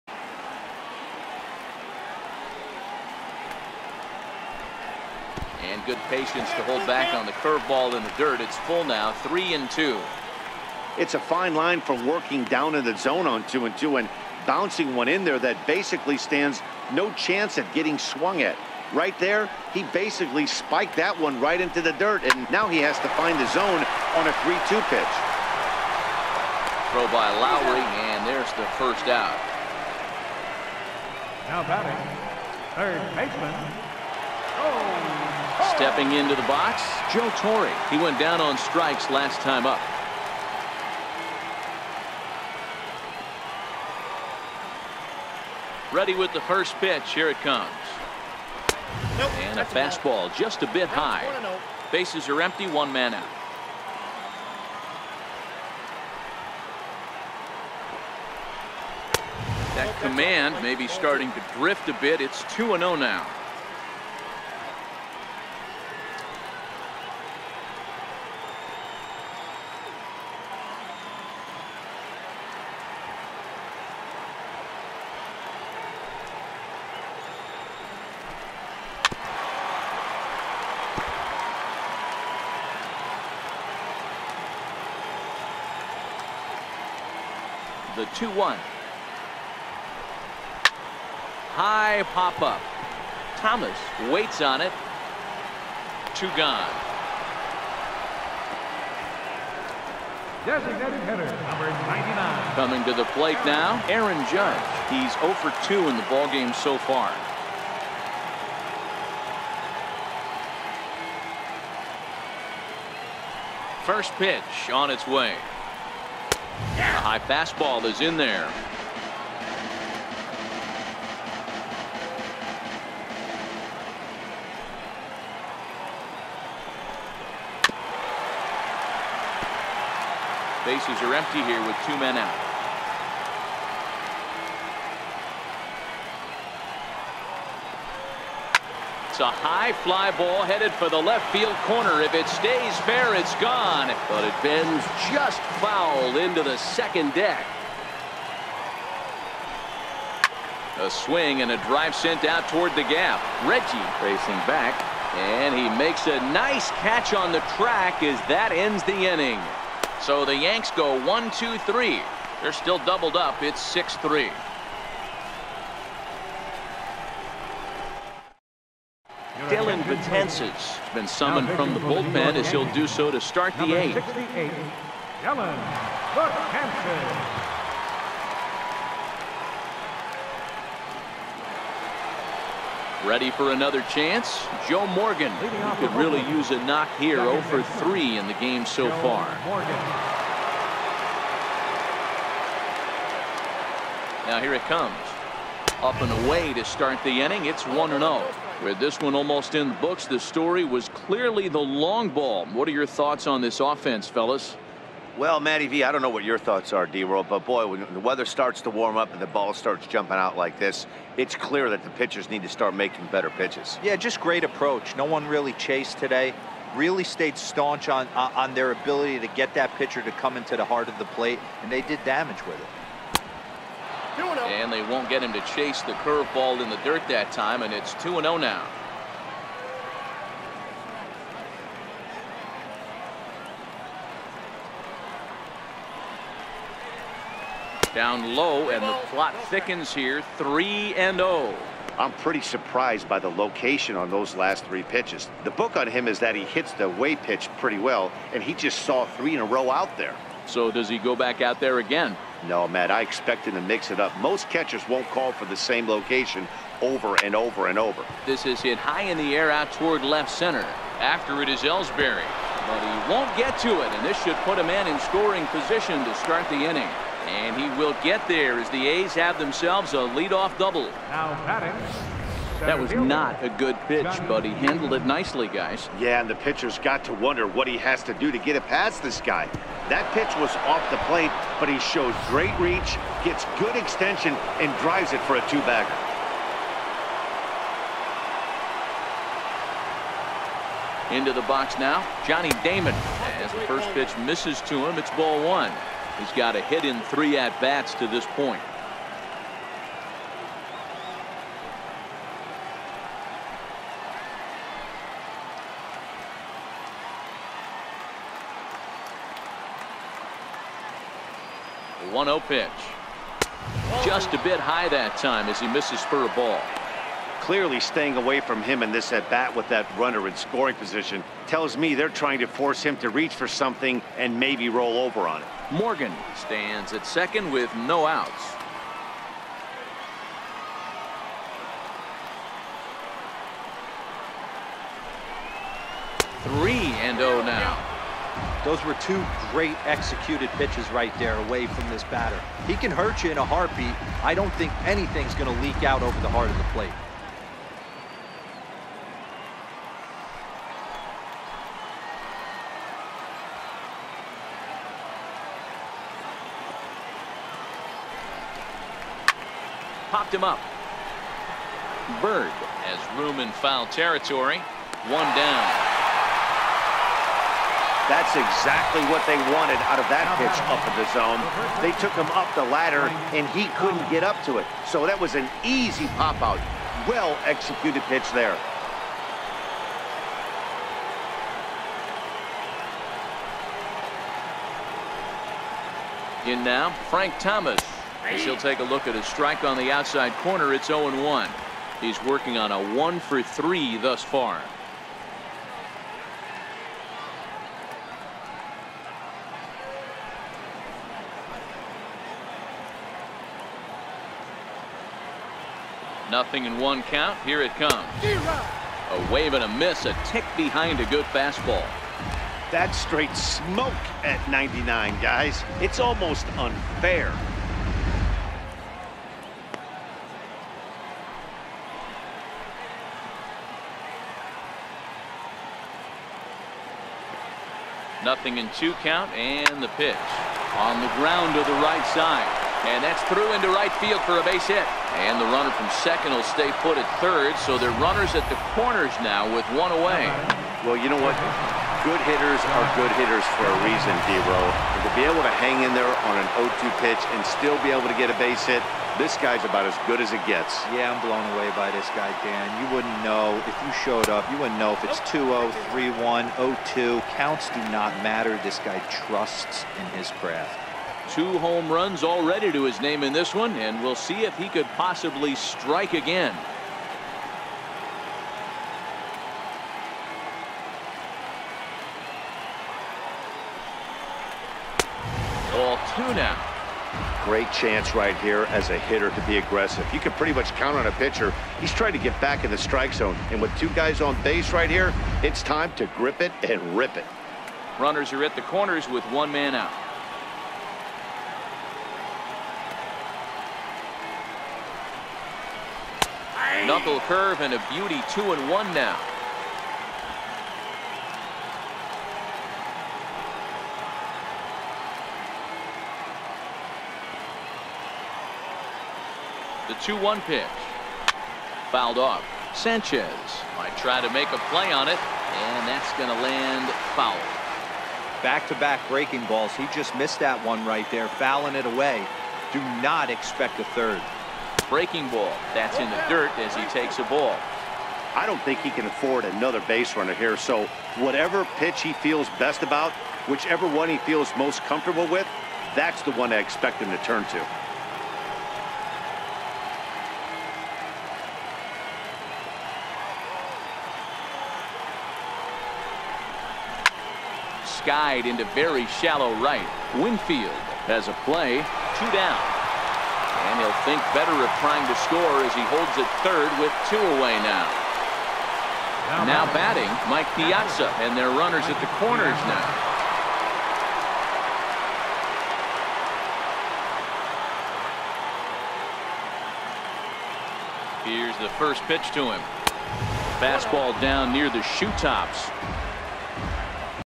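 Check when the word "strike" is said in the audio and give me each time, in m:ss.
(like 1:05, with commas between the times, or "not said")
0:38, 6:29, 7:45, 8:02.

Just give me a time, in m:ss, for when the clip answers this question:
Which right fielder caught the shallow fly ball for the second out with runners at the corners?
9:10.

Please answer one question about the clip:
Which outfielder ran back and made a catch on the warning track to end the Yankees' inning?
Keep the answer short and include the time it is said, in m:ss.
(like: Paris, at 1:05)
Reggie, at 2:33.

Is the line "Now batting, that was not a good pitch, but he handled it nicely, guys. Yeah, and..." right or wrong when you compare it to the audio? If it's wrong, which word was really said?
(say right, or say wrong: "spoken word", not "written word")
right.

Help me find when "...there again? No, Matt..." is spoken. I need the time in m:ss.
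4:11.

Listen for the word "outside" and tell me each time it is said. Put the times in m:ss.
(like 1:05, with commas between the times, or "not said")
6:29.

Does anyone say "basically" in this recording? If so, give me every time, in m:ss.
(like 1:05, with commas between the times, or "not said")
0:15, 0:19.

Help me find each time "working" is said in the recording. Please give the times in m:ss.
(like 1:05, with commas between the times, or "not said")
0:12, 6:32.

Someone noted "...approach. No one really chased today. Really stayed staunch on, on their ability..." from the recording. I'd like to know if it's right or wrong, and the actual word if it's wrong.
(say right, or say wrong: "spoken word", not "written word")
right.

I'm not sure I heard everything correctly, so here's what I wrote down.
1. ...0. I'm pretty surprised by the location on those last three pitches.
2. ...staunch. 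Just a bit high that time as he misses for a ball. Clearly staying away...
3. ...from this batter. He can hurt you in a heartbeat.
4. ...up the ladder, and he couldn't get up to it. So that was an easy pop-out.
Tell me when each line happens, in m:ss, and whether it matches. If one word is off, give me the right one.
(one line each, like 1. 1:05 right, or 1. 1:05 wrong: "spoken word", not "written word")
1. 4:01 right
2. 5:12 wrong: "pitch", not "staunch"
3. 5:41 right
4. 6:12 right.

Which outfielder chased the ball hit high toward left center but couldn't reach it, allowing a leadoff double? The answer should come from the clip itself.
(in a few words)
Ellsbury.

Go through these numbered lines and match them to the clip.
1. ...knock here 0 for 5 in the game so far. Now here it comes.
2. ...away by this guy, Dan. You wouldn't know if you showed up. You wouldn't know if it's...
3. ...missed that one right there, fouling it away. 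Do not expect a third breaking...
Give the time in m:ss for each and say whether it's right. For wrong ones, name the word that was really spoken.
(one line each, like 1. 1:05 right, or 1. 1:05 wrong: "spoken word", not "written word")
1. 3:06 wrong: "3", not "5"
2. 7:31 right
3. 8:40 right.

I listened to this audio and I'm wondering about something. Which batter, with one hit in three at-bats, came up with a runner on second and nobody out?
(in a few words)
Johnny Damon.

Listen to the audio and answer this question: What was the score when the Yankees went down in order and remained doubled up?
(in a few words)
6-3.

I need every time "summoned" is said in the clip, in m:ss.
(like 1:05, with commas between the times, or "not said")
2:51.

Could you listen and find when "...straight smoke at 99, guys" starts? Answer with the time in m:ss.
6:52.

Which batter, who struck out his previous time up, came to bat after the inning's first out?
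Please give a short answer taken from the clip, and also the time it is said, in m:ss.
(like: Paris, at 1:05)
Joe Torre, at 0:37.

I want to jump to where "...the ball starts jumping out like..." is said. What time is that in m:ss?
3:29.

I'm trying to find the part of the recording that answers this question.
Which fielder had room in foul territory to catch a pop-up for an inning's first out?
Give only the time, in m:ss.
6:02.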